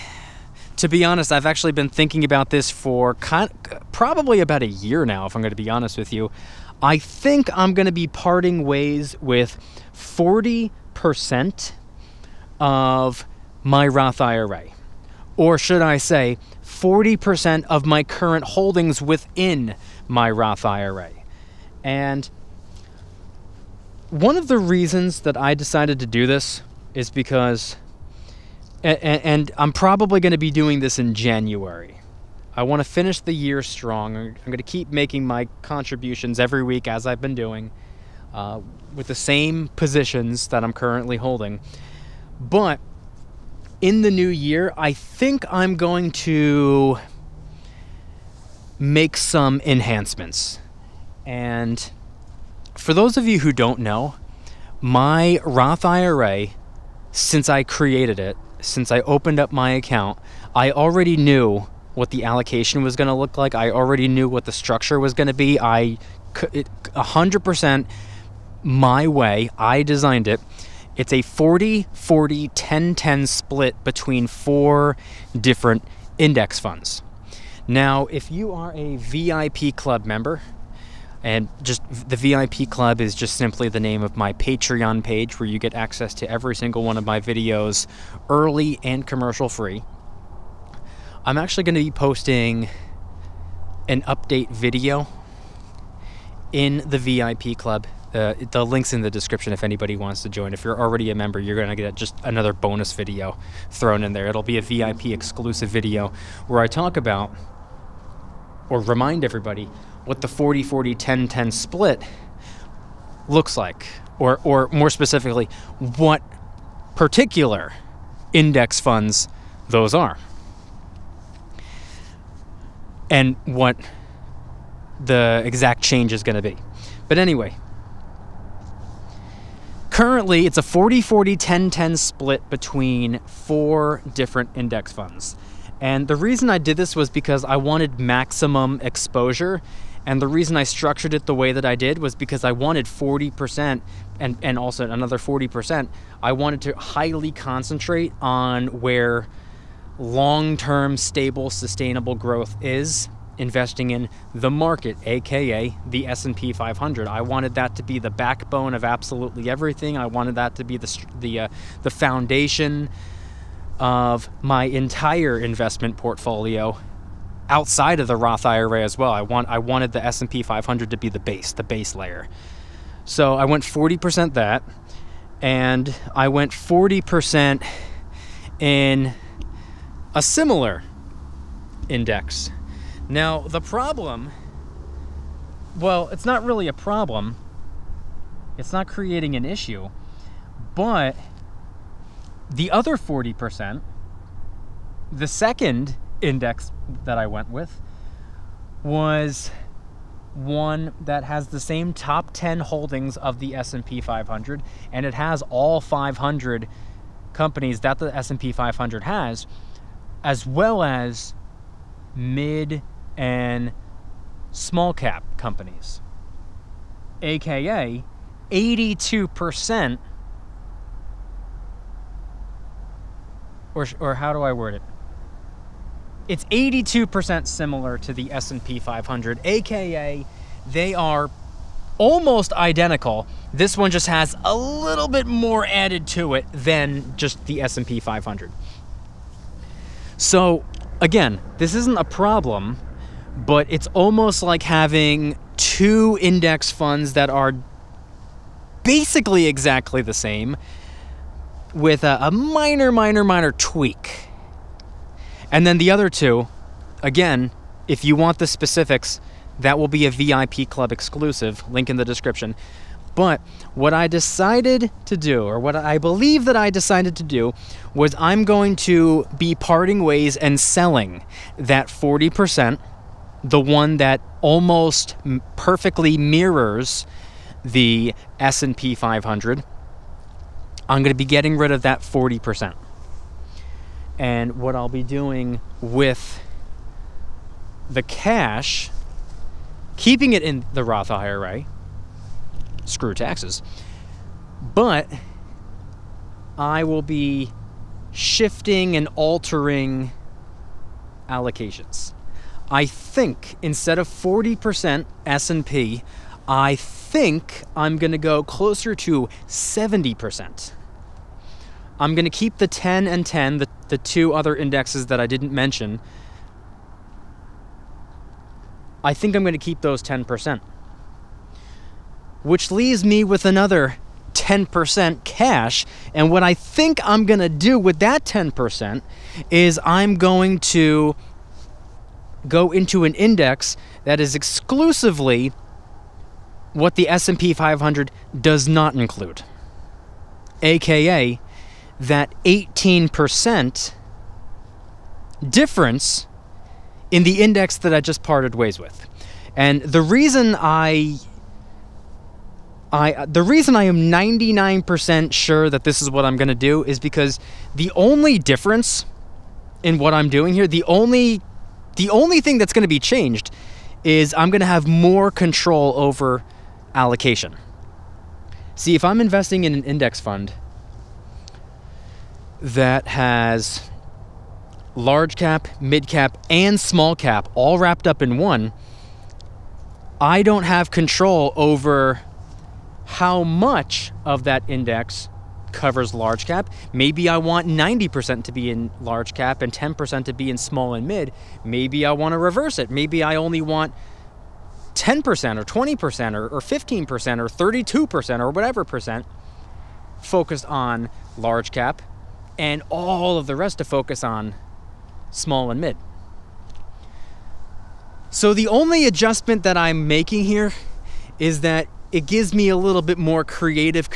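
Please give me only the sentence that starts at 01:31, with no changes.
I'm actually going to be posting an update video in the VIP Club.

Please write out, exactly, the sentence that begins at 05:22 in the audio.
Which leaves me with another 10% cash.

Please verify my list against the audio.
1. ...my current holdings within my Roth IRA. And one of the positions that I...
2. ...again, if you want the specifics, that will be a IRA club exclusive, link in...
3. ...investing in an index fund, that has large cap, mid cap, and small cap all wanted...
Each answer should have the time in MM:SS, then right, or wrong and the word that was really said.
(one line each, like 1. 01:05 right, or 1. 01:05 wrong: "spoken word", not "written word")
1. 00:17 wrong: "reasons", not "positions"
2. 04:17 wrong: "VIP", not "IRA"
3. 06:09 wrong: "wrapped", not "wanted".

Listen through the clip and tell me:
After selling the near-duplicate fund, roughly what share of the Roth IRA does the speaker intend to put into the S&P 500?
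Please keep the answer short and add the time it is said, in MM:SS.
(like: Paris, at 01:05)
70%, at 05:09.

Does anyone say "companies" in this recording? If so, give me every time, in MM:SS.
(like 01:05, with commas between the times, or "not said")
03:27, 03:35.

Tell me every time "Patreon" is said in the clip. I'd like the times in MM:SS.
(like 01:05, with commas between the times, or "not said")
01:24.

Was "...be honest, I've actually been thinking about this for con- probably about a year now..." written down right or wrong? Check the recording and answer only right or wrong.
right.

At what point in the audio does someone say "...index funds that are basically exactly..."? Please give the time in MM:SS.
04:06.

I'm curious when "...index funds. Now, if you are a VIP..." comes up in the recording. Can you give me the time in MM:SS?
01:16.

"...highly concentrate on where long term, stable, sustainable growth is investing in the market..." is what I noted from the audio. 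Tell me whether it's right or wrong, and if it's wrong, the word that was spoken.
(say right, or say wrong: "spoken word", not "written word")
right.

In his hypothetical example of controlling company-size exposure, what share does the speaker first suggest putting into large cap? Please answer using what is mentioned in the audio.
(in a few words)
90%.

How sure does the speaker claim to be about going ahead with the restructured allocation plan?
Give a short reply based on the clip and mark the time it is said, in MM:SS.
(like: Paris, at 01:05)
99%, at 05:54.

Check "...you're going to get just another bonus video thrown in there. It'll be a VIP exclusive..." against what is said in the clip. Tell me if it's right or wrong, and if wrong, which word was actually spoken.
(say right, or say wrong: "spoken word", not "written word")
right.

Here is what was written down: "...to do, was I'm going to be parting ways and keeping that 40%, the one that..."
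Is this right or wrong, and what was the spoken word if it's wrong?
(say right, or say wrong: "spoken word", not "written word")
wrong: "selling", not "keeping".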